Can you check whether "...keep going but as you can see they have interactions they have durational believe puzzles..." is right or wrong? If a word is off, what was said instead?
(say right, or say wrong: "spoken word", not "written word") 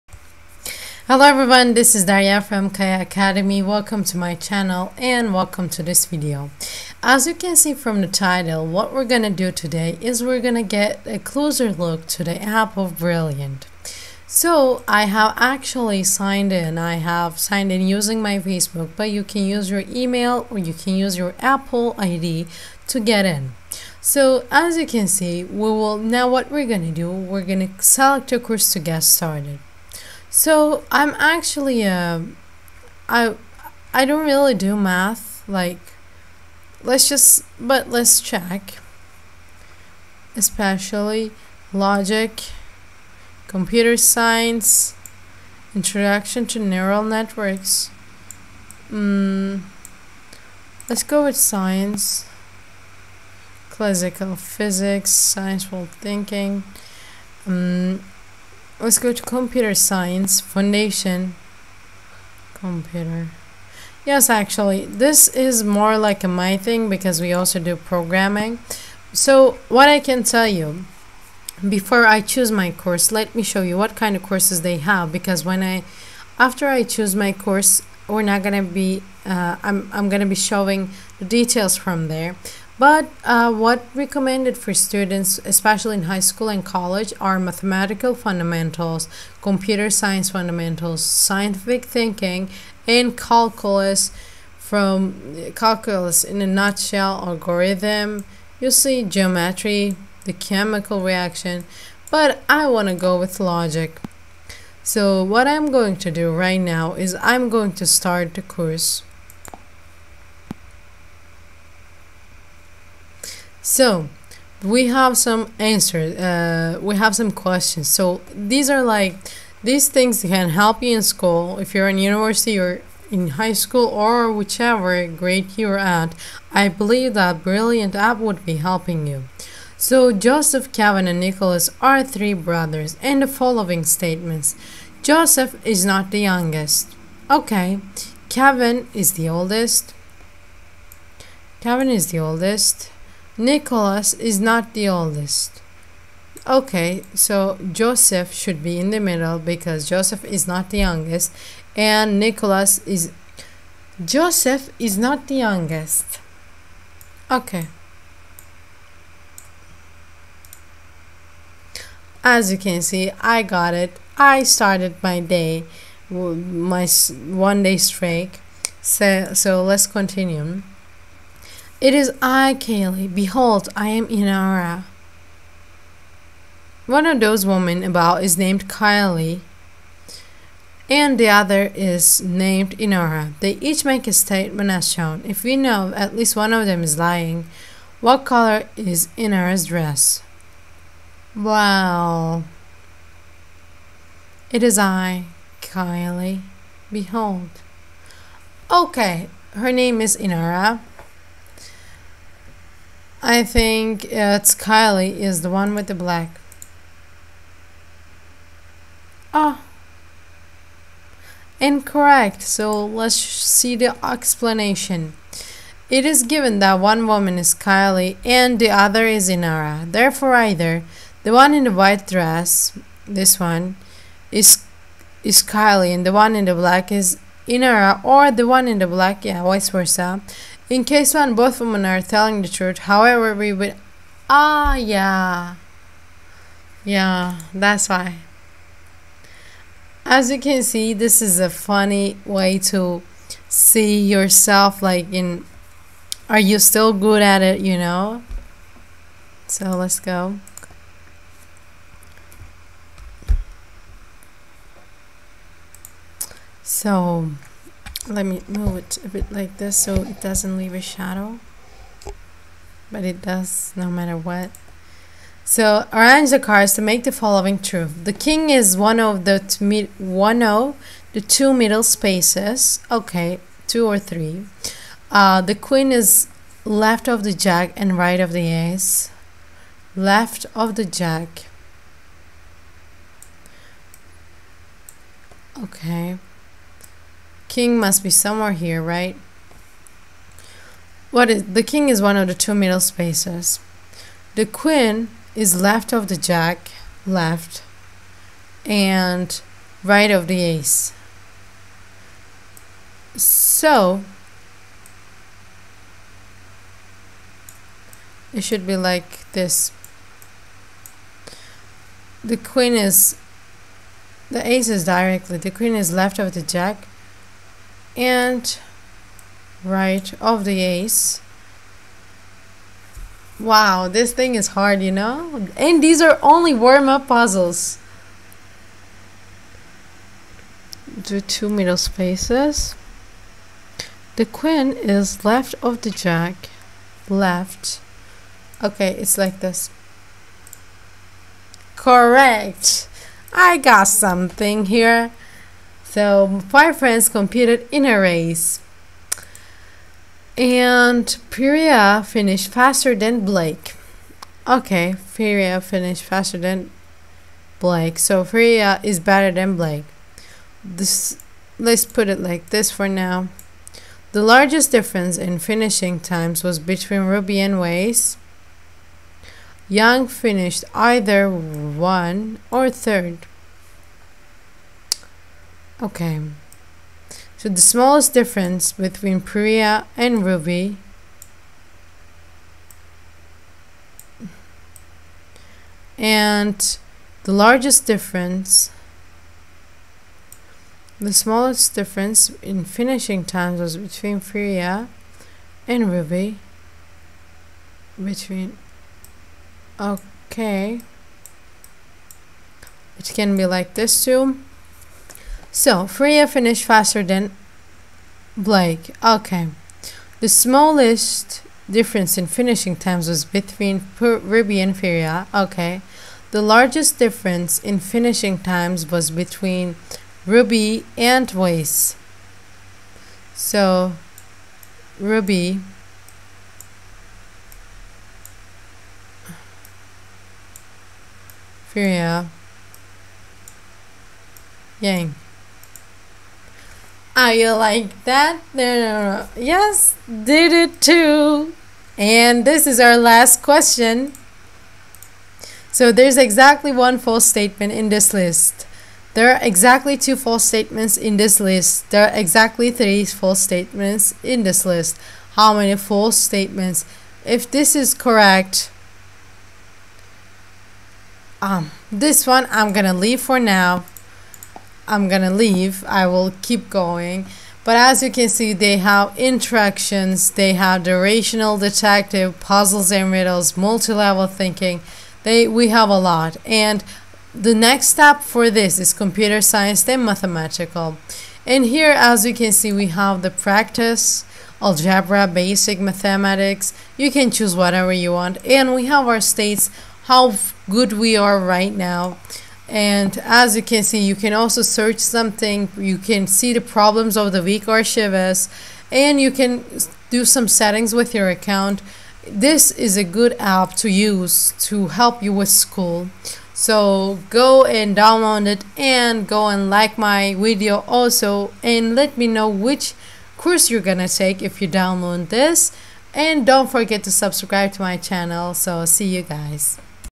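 wrong: "detective", not "believe".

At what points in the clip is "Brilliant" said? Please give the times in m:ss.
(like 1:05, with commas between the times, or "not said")
0:12, 2:07.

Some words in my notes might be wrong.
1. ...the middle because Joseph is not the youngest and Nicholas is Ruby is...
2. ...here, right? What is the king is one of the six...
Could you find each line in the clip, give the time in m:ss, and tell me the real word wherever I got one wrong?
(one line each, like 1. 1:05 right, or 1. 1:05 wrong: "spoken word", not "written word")
1. 2:28 wrong: "Joseph", not "Ruby"
2. 4:48 wrong: "two", not "six".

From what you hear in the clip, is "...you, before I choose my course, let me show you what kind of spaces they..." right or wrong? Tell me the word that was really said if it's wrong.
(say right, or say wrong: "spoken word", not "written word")
wrong: "courses", not "spaces".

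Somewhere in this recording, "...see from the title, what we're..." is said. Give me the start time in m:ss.
0:07.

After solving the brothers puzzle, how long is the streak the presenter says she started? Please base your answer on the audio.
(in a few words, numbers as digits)
one day.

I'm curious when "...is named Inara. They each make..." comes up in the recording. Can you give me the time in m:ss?
3:01.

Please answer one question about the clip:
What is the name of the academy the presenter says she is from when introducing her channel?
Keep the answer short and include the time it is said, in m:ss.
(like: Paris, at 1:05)
Kaya Academy, at 0:02.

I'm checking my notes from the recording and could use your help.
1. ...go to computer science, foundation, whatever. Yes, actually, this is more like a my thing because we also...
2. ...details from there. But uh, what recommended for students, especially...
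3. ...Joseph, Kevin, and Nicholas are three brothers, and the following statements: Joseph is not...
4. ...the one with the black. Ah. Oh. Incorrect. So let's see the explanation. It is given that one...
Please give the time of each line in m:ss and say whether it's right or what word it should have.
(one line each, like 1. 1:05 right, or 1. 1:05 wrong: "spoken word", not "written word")
1. 0:58 wrong: "computer", not "whatever"
2. 1:21 right
3. 2:10 right
4. 3:25 right.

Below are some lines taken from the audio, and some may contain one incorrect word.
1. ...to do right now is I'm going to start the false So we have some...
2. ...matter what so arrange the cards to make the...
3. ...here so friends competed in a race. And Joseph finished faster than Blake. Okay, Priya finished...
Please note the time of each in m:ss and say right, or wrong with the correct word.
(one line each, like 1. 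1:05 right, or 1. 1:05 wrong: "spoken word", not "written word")
1. 1:45 wrong: "course", not "false"
2. 4:23 right
3. 5:44 wrong: "Priya", not "Joseph".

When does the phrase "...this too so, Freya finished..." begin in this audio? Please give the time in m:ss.
6:43.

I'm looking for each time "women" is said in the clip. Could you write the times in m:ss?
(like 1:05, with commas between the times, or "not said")
2:57, 3:51.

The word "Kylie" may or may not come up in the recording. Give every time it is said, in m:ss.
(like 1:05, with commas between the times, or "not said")
2:58, 3:15, 3:24, 3:37, 3:45.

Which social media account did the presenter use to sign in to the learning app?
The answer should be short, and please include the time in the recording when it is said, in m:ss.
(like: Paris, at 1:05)
Facebook, at 0:18.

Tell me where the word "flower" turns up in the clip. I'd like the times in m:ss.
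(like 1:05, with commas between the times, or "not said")
not said.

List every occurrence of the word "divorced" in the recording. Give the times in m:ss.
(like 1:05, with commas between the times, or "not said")
not said.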